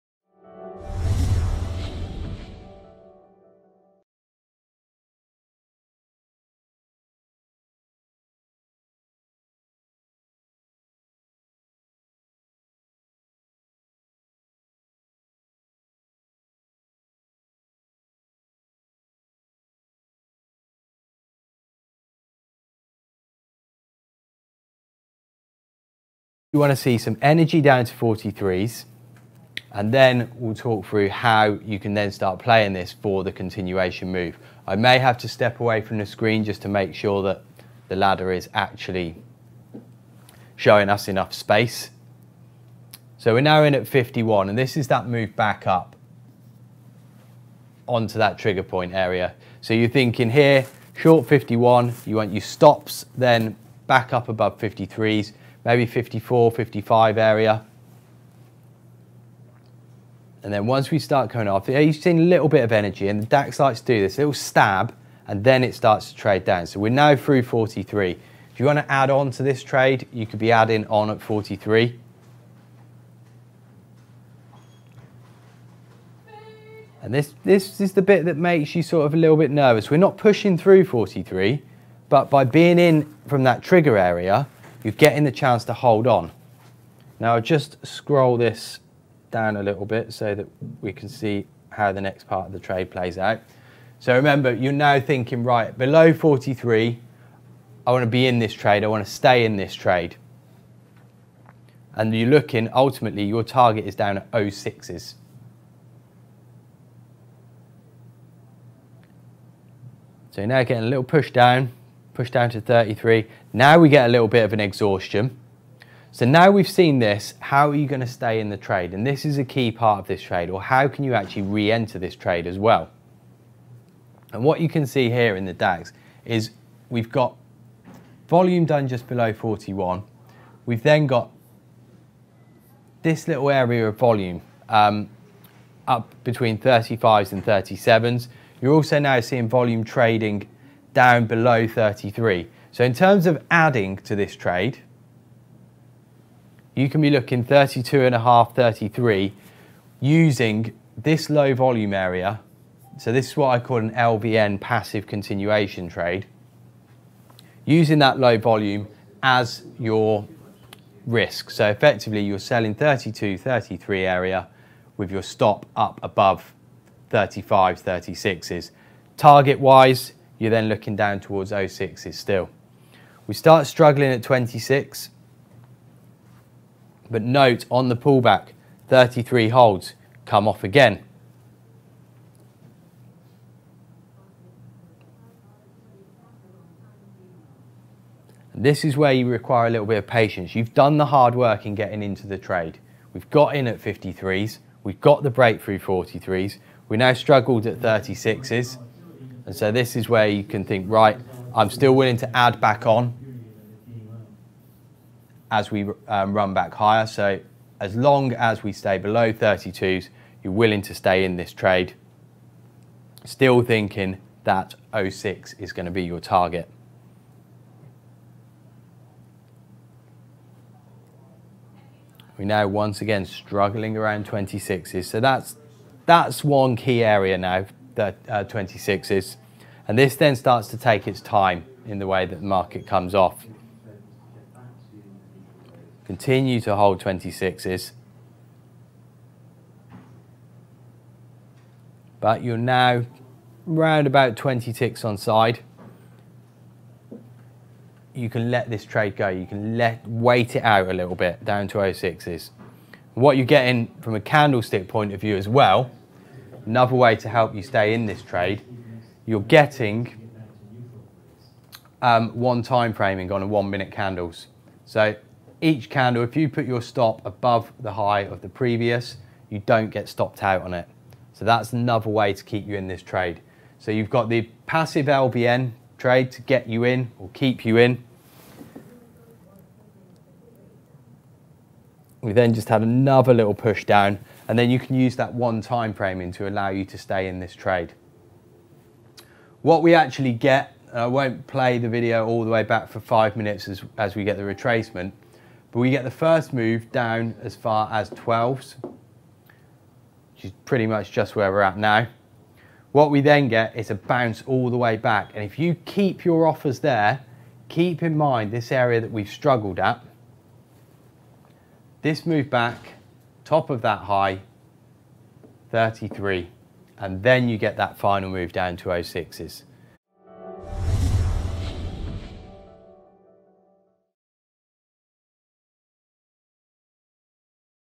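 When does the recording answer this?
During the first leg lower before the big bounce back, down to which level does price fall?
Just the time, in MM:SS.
04:58.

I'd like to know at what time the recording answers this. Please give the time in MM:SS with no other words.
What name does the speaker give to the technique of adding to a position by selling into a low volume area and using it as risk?
02:33.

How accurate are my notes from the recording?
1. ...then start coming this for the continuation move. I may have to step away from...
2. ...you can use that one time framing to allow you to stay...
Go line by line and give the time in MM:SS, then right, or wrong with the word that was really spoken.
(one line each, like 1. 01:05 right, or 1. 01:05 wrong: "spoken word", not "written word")
1. 00:31 wrong: "playing", not "coming"
2. 04:44 right.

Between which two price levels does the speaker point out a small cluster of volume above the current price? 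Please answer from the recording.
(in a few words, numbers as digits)
35 and 37.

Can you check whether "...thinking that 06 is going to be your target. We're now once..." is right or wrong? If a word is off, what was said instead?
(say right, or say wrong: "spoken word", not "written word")
right.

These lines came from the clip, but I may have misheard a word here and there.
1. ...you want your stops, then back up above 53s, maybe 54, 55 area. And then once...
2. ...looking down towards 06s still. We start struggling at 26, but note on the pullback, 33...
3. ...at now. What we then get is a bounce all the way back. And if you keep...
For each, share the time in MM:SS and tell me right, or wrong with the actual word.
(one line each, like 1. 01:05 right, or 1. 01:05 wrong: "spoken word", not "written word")
1. 00:52 right
2. 02:50 right
3. 05:01 right.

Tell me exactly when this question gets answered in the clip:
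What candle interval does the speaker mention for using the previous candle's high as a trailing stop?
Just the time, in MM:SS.
04:23.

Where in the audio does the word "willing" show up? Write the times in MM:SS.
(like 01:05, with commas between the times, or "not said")
03:21, 03:30.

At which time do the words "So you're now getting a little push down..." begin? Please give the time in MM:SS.
01:50.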